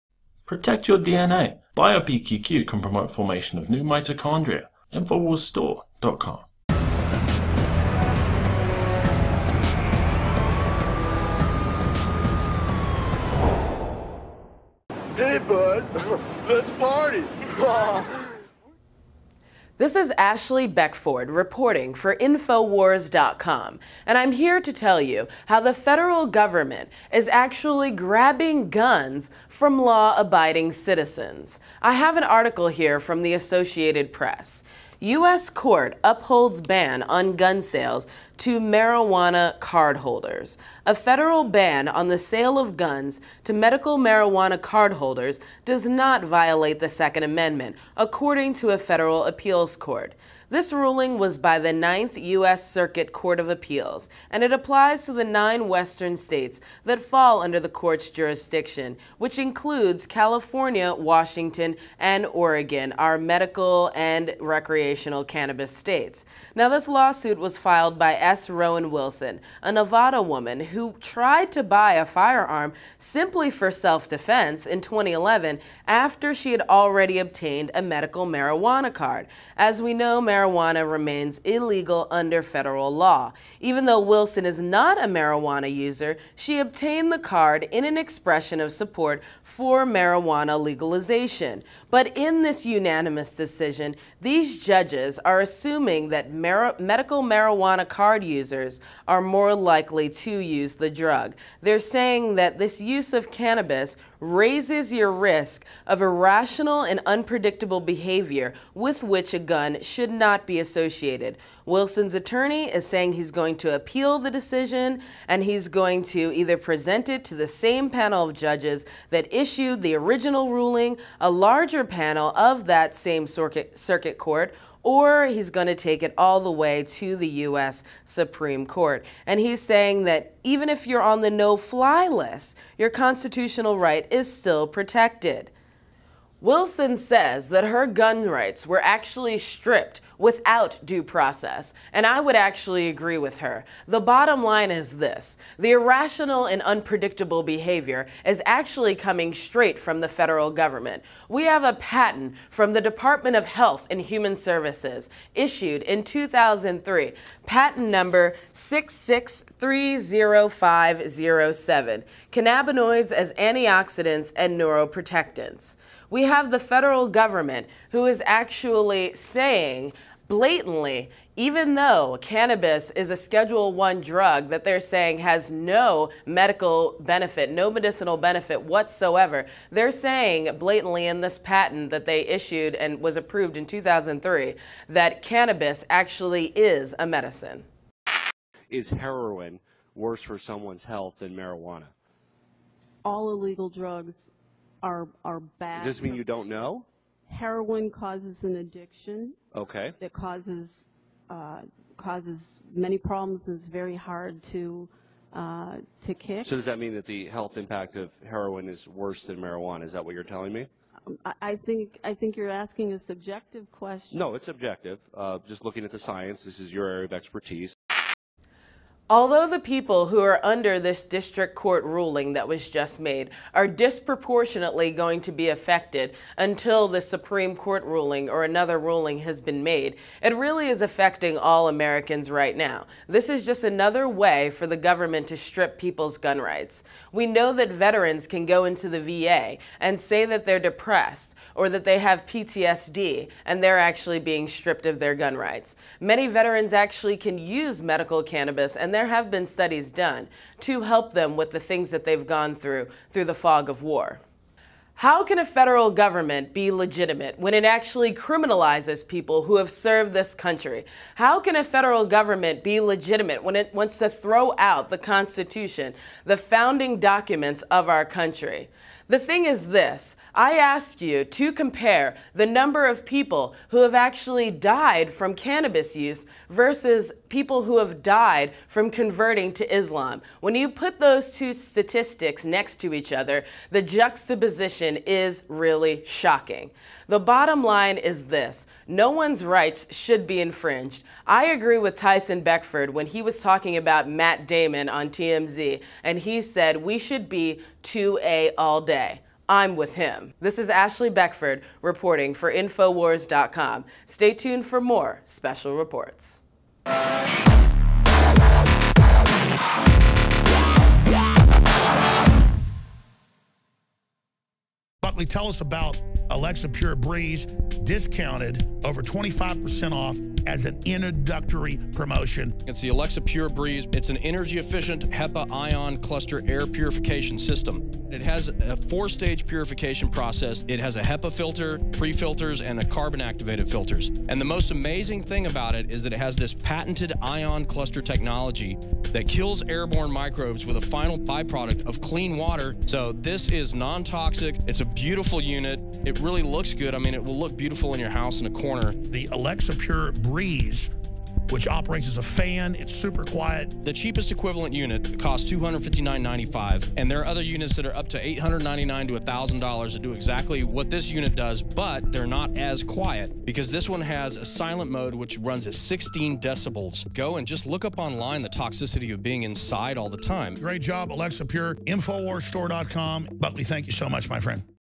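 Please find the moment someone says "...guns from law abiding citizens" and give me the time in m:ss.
0:28.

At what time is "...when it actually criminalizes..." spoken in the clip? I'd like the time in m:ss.
4:17.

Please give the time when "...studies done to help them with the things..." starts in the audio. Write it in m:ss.
4:09.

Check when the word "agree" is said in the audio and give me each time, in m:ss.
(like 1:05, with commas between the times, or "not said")
2:22, 4:51.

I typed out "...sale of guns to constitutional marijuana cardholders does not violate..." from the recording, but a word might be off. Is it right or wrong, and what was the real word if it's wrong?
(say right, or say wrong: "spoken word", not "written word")
wrong: "medical", not "constitutional".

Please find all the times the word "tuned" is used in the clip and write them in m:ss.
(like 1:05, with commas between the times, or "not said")
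5:04.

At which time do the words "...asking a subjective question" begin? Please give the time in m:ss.
3:32.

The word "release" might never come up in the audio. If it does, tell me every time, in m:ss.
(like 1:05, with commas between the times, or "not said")
not said.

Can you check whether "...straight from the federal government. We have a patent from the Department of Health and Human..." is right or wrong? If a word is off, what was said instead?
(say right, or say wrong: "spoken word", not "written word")
right.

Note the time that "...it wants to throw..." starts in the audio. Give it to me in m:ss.
4:23.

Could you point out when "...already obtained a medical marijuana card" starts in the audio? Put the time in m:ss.
1:16.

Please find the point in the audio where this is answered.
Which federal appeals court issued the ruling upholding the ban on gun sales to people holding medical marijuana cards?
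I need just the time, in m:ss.
0:51.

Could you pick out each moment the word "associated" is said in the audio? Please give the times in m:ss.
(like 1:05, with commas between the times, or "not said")
0:33, 1:50.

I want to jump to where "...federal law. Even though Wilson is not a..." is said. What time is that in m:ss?
1:22.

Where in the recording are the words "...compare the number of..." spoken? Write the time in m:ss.
4:31.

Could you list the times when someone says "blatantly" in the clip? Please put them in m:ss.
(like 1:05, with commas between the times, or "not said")
2:50, 3:00.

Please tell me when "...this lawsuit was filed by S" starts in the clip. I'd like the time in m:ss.
1:06.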